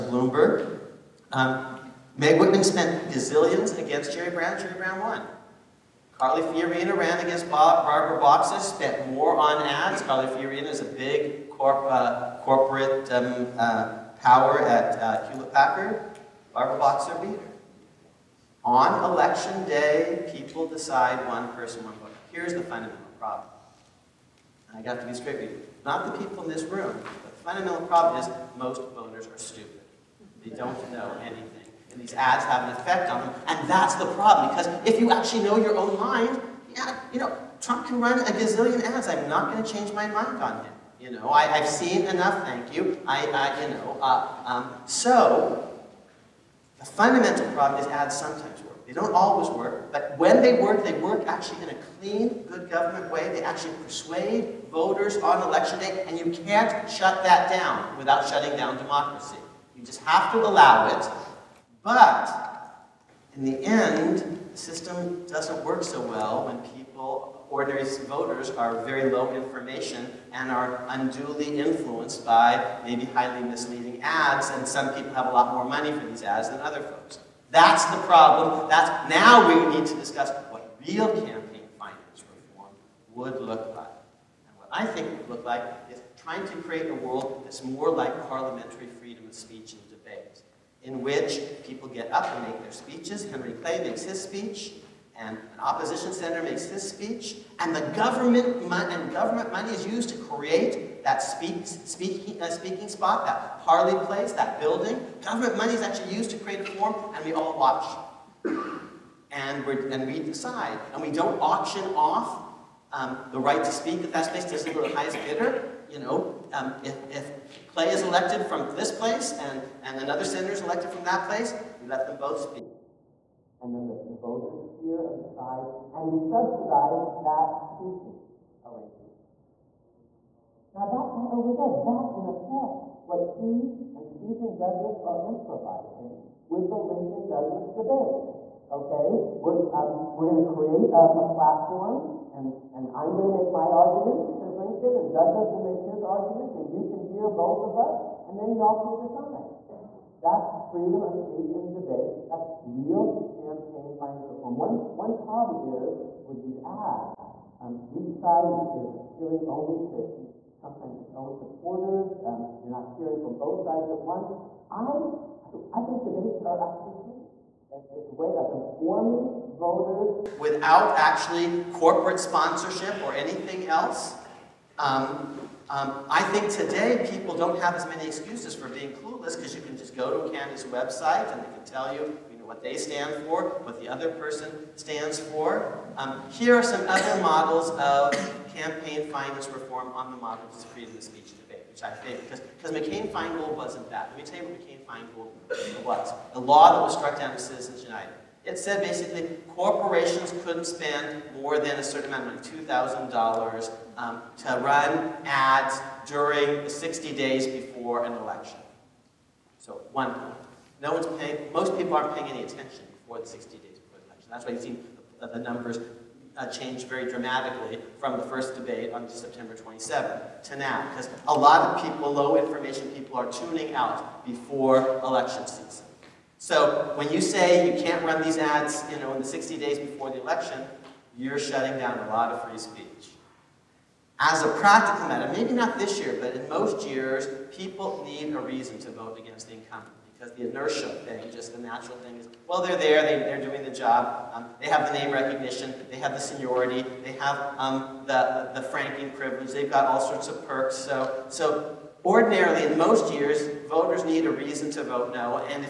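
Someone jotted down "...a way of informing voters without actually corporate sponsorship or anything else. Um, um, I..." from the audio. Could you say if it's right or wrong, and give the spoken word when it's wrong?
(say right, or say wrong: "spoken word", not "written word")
right.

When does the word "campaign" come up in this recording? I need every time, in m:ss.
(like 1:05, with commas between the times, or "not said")
1:21, 2:33, 3:08.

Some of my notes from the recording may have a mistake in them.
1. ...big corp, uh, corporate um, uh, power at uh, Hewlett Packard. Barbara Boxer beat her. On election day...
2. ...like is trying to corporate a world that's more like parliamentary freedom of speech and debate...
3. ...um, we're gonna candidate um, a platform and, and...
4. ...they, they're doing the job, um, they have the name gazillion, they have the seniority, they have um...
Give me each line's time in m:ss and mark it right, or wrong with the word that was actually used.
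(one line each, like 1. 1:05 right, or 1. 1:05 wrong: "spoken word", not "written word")
1. 0:10 right
2. 1:25 wrong: "create", not "corporate"
3. 2:19 wrong: "create", not "candidate"
4. 4:03 wrong: "recognition", not "gazillion".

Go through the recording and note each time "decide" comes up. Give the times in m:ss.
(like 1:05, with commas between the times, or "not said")
0:20, 1:50, 2:05, 2:29.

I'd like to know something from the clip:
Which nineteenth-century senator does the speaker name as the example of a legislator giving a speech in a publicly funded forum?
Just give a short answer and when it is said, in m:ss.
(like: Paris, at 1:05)
Henry Clay, at 1:33.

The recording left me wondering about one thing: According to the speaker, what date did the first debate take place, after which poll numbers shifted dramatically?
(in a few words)
September 27.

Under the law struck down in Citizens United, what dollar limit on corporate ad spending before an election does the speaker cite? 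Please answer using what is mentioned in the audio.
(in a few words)
$2,000.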